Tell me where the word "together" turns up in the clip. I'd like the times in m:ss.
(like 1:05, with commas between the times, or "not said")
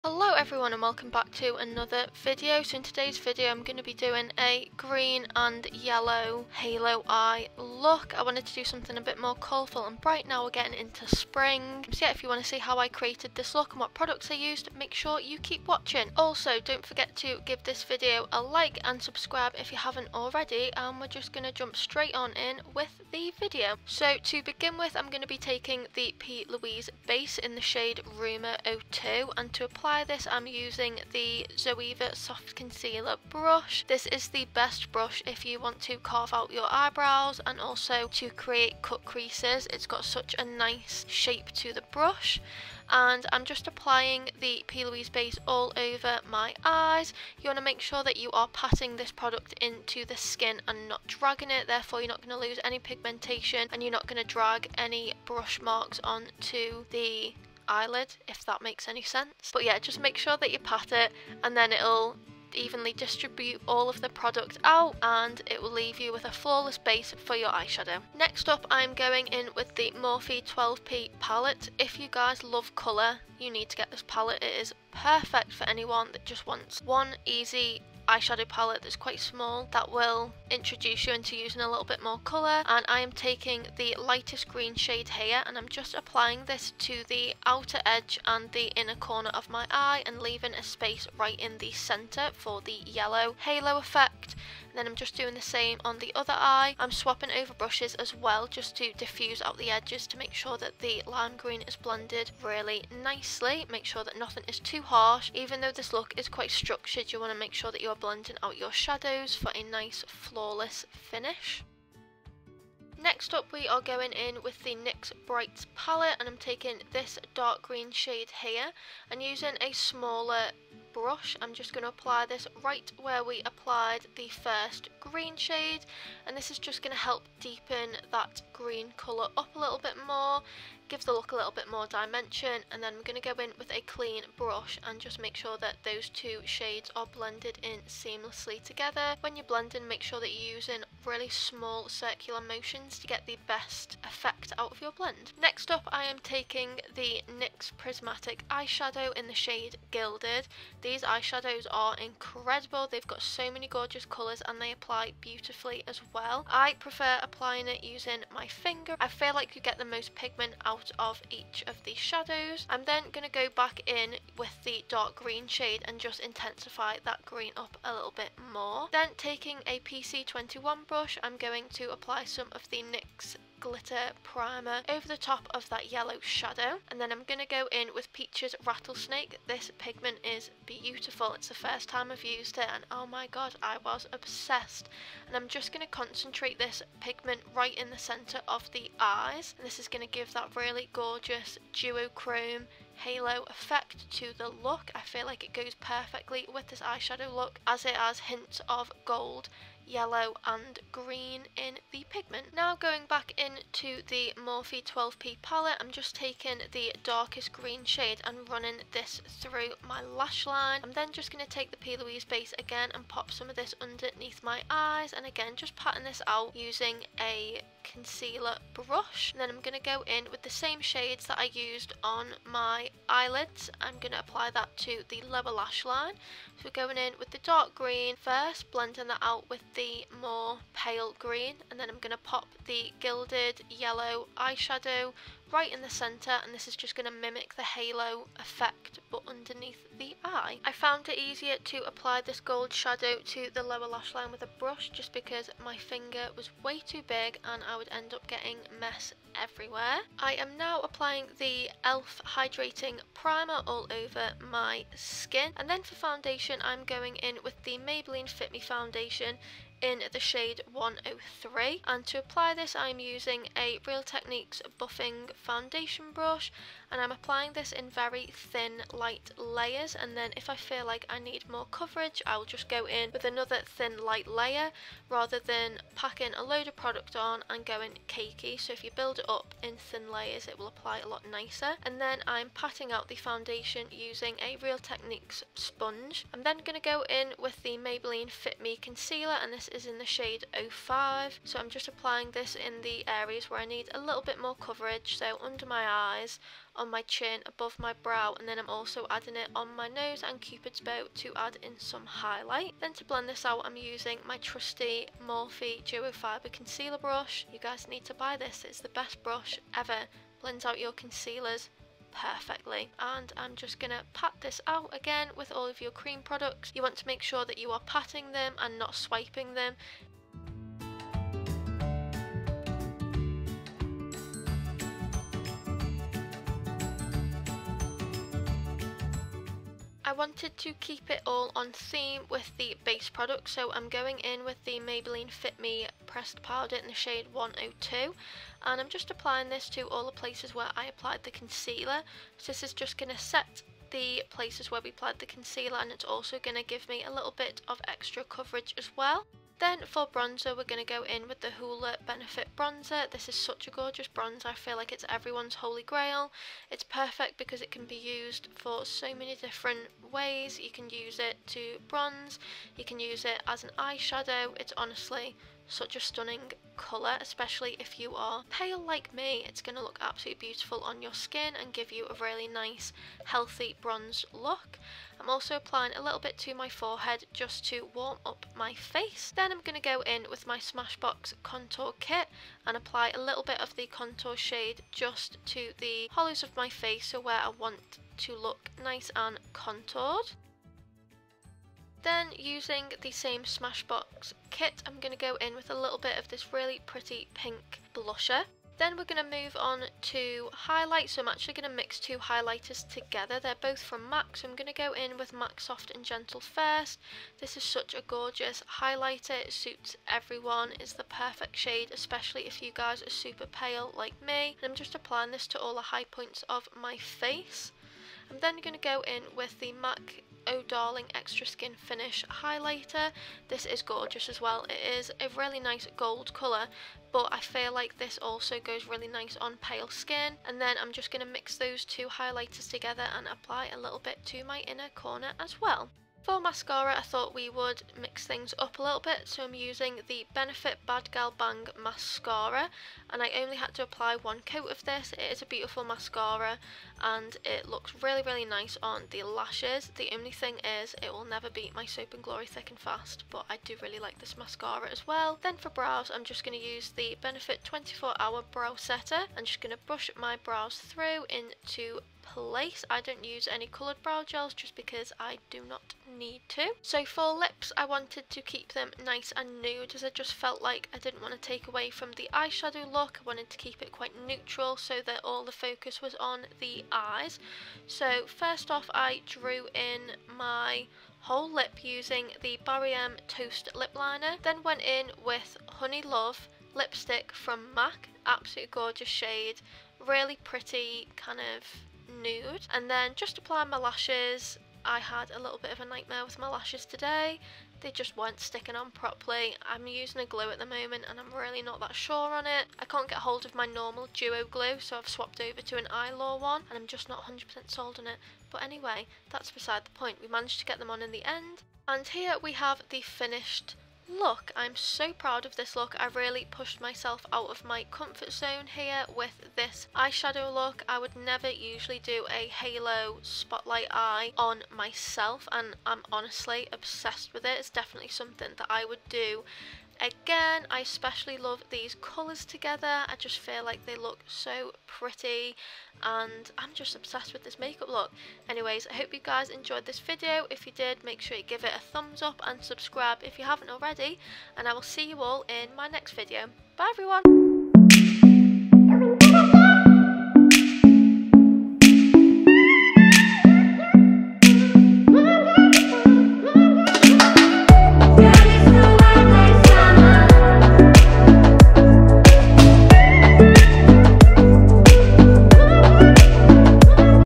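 2:18, 6:42, 7:12, 8:52.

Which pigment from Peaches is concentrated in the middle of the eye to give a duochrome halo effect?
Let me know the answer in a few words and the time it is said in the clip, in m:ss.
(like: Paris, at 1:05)
Rattlesnake, at 2:58.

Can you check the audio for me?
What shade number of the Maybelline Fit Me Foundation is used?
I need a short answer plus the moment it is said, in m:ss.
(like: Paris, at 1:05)
103, at 4:20.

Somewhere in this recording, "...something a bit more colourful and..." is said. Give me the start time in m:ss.
0:08.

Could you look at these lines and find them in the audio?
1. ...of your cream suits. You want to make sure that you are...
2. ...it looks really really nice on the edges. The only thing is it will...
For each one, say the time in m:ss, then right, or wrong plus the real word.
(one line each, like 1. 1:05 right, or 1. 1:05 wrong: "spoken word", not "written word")
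1. 5:15 wrong: "products", not "suits"
2. 7:27 wrong: "lashes", not "edges".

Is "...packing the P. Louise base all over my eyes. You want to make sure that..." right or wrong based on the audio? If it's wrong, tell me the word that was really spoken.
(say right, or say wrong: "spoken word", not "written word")
wrong: "applying", not "packing".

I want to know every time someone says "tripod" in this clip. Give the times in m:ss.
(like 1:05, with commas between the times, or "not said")
not said.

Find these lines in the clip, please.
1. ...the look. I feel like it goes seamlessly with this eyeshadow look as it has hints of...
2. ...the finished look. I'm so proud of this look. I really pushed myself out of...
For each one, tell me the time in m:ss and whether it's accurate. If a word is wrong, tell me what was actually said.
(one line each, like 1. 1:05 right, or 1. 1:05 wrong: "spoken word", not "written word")
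1. 3:14 wrong: "perfectly", not "seamlessly"
2. 8:32 right.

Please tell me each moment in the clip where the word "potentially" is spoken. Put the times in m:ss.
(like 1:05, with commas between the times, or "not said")
not said.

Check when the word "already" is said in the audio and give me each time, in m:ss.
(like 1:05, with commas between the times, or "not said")
0:20, 9:03.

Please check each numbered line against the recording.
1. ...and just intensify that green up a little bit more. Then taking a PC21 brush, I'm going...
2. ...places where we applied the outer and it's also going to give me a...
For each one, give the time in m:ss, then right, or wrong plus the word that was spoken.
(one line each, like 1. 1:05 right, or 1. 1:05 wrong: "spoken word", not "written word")
1. 2:45 right
2. 5:44 wrong: "concealer", not "outer".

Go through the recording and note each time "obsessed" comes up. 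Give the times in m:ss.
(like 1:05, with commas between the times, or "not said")
3:04, 8:46, 8:56.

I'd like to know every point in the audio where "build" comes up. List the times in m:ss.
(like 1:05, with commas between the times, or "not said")
4:38.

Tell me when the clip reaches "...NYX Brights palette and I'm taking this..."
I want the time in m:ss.
1:54.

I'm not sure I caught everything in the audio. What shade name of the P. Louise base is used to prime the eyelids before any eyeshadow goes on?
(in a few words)
Rumour 02.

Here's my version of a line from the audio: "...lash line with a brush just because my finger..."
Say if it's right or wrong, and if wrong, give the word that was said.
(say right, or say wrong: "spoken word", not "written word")
right.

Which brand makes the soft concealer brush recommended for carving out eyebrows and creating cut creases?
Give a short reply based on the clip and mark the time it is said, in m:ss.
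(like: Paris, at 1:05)
Zoeva, at 0:31.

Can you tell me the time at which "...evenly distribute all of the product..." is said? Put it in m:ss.
1:02.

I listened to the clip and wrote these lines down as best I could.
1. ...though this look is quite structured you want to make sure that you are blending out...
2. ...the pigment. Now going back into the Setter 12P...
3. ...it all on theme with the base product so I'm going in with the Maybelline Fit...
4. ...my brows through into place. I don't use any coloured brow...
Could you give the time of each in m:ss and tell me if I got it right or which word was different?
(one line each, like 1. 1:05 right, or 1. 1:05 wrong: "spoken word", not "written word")
1. 1:45 right
2. 3:21 wrong: "Morphe", not "Setter"
3. 5:31 right
4. 7:40 right.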